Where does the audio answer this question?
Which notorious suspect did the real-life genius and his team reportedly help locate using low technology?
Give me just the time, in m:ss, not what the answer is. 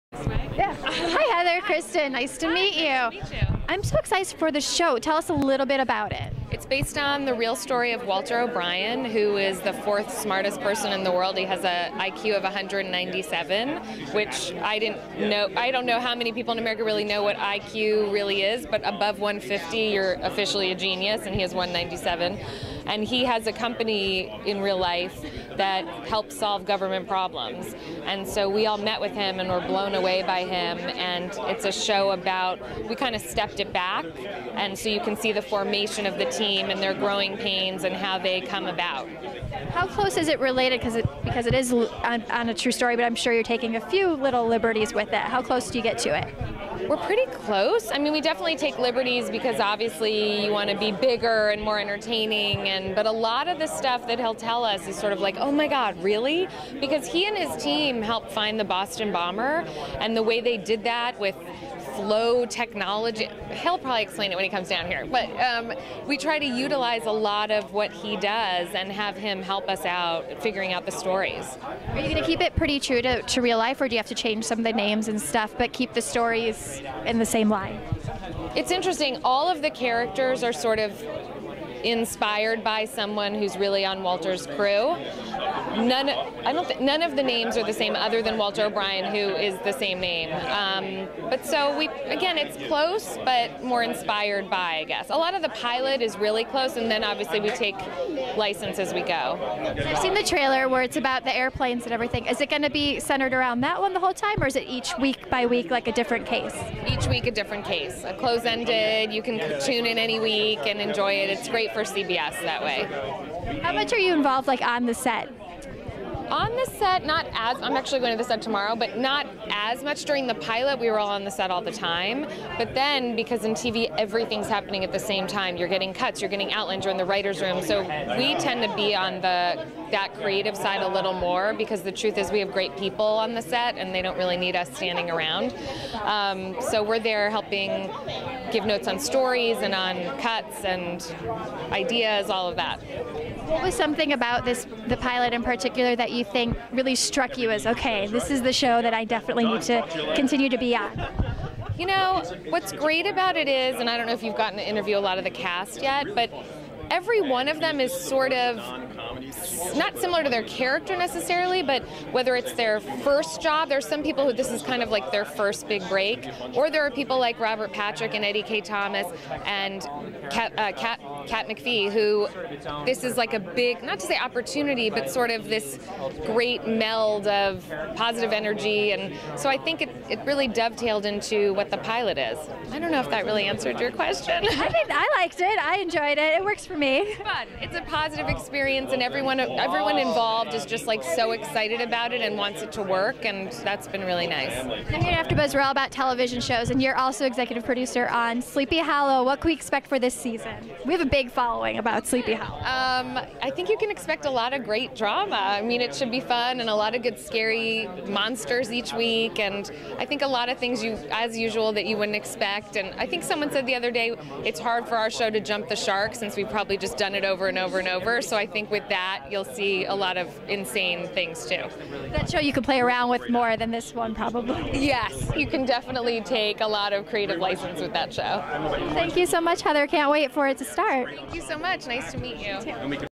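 0:58.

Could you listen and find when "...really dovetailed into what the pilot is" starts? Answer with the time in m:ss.
3:00.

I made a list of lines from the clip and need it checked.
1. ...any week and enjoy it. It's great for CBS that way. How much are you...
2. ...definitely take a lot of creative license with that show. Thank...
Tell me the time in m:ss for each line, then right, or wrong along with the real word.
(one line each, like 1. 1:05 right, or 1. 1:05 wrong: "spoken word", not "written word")
1. 1:49 right
2. 3:45 right.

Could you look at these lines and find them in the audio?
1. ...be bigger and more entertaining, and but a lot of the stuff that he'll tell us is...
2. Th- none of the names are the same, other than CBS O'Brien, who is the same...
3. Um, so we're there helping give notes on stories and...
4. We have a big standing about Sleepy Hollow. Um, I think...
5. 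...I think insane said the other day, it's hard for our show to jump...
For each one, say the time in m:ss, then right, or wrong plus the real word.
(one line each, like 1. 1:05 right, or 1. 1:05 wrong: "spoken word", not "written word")
1. 0:50 right
2. 1:26 wrong: "Walter", not "CBS"
3. 2:16 right
4. 3:20 wrong: "following", not "standing"
5. 3:32 wrong: "someone", not "insane".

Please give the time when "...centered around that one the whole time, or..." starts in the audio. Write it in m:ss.
1:42.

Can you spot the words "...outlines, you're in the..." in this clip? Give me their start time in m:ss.
2:06.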